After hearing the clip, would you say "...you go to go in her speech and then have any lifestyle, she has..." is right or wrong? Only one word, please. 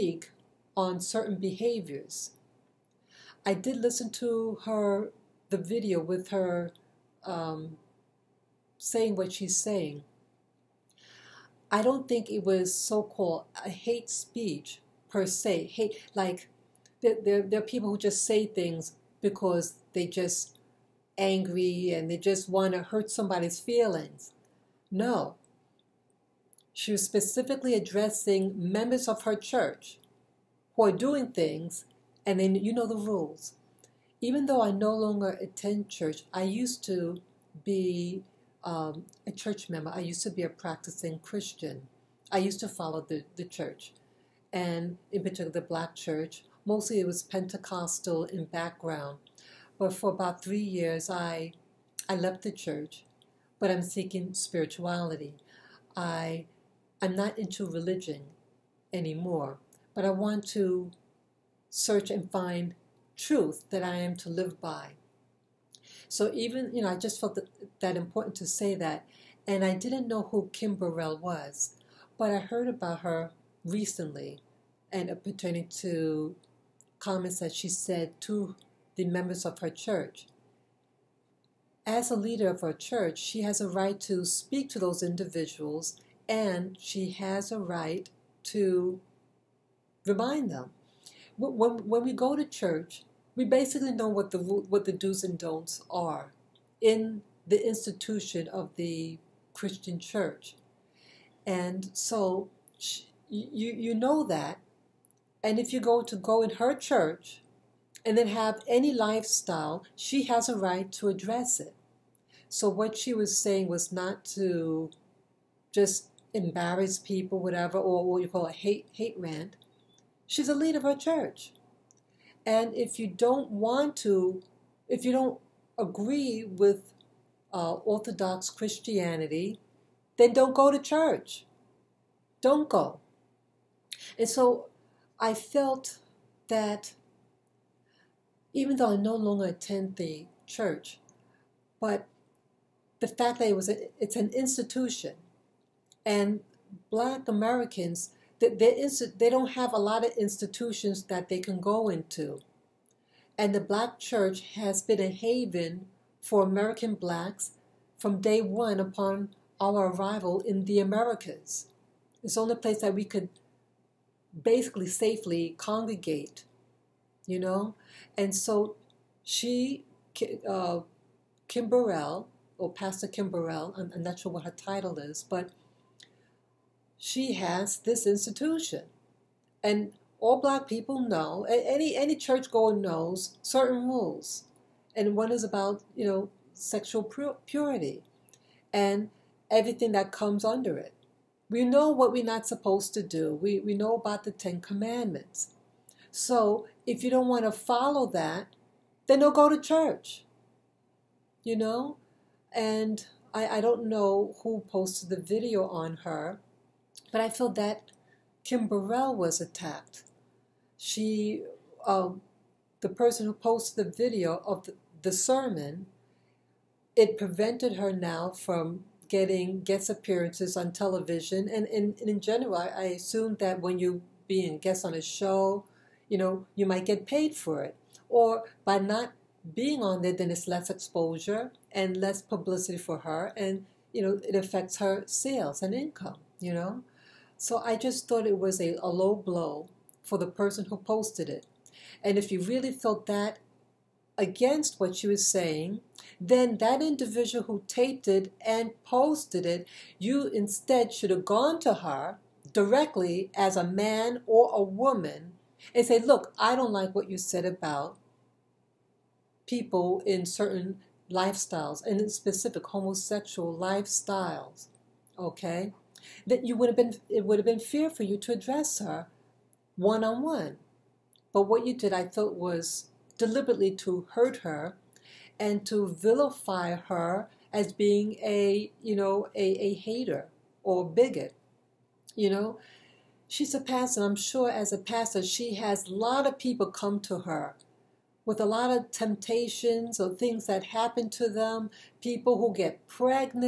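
wrong.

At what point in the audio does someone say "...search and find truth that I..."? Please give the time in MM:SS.
01:01.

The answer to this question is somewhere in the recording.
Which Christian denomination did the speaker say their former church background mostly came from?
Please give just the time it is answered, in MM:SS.
00:47.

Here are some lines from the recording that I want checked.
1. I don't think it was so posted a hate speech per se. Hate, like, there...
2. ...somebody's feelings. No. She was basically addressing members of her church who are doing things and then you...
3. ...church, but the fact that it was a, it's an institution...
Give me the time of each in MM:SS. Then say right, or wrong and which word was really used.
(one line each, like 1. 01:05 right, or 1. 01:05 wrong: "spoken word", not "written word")
1. 00:11 wrong: "called", not "posted"
2. 00:23 wrong: "specifically", not "basically"
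3. 02:20 right.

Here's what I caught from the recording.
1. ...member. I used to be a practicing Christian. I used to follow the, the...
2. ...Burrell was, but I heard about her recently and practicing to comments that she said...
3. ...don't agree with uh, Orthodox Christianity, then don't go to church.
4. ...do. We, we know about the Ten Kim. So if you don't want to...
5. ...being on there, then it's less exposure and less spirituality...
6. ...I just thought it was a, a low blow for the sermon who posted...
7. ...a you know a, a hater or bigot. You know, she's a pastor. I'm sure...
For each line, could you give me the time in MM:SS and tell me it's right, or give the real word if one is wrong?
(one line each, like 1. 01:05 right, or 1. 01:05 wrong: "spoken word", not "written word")
1. 00:39 right
2. 01:10 wrong: "pertaining", not "practicing"
3. 02:05 right
4. 03:13 wrong: "Commandments", not "Kim"
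5. 03:49 wrong: "publicity", not "spirituality"
6. 03:57 wrong: "person", not "sermon"
7. 04:38 right.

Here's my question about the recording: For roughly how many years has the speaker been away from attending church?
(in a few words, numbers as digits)
3 years.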